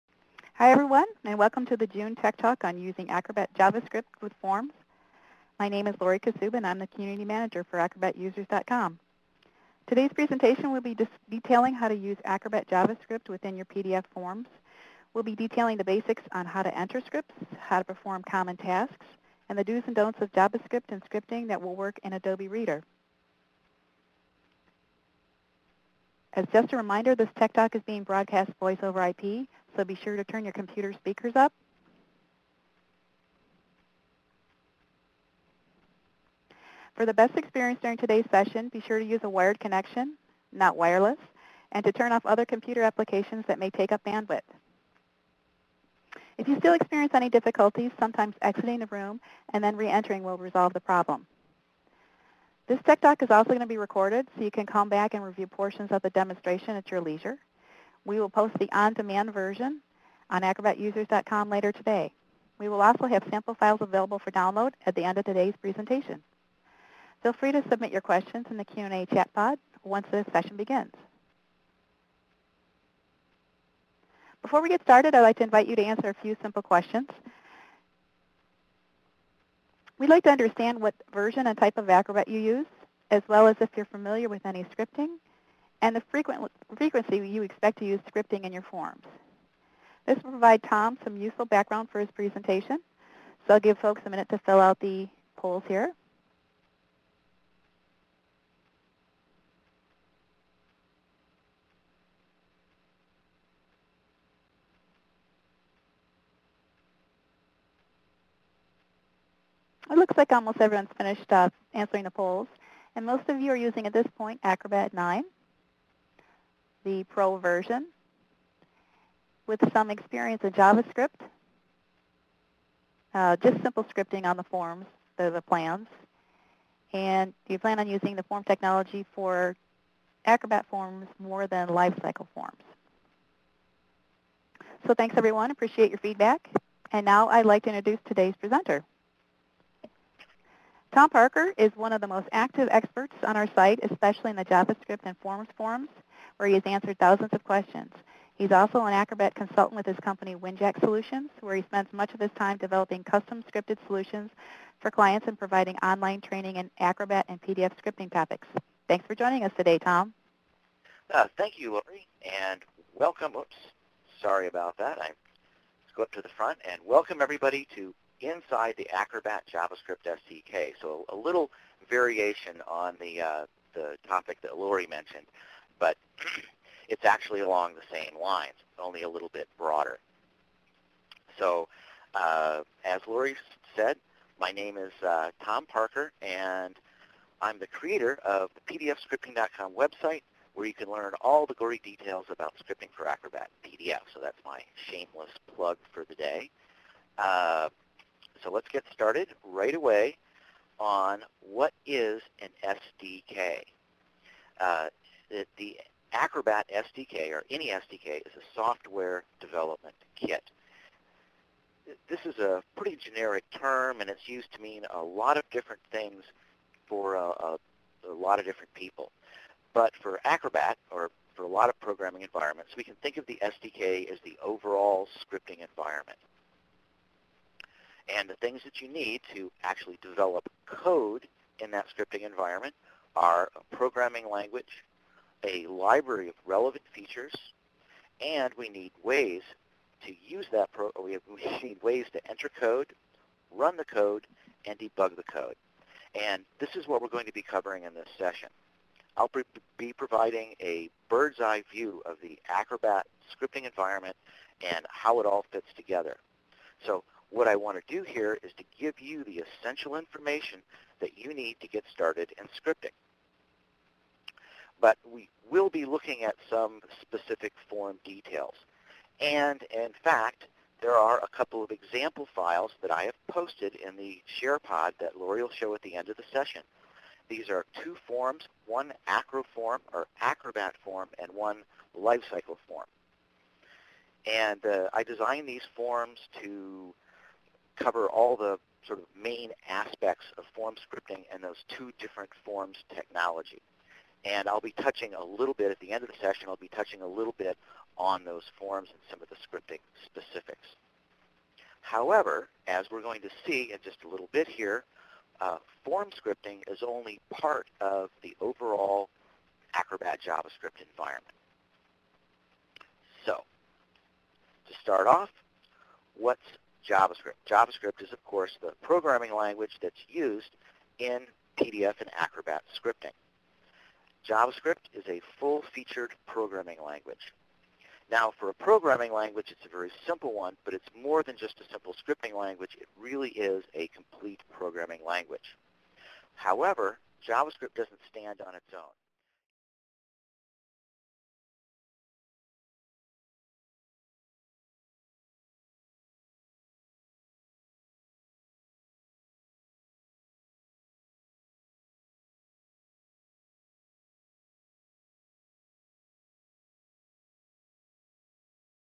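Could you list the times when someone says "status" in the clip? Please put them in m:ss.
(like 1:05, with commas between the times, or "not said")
not said.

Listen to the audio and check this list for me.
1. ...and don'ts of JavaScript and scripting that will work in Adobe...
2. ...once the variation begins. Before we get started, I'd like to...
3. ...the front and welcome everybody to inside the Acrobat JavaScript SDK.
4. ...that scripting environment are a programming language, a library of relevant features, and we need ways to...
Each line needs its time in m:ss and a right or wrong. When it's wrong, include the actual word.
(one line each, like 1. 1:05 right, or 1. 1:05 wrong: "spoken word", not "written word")
1. 0:19 right
2. 1:09 wrong: "session", not "variation"
3. 2:46 right
4. 3:51 right.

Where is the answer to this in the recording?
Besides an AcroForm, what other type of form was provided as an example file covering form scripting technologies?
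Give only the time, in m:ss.
4:41.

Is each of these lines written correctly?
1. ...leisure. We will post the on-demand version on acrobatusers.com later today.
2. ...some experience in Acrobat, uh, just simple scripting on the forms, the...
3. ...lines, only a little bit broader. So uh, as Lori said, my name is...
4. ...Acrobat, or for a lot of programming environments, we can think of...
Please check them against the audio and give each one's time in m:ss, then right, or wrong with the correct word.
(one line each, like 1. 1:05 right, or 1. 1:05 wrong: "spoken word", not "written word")
1. 0:57 right
2. 1:59 wrong: "JavaScript", not "Acrobat"
3. 2:58 right
4. 3:40 right.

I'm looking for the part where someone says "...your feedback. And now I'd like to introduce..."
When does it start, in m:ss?
2:15.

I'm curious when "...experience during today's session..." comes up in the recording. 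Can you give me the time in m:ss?
0:37.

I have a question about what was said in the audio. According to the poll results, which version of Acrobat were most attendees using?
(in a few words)
Acrobat 9.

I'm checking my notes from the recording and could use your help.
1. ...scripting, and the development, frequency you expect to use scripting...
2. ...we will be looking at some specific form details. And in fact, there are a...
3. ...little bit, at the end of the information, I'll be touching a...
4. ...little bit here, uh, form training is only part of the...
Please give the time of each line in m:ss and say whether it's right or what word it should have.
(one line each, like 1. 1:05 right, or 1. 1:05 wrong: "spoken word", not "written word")
1. 1:24 wrong: "frequent", not "development"
2. 4:25 right
3. 4:55 wrong: "session", not "information"
4. 5:04 wrong: "scripting", not "training".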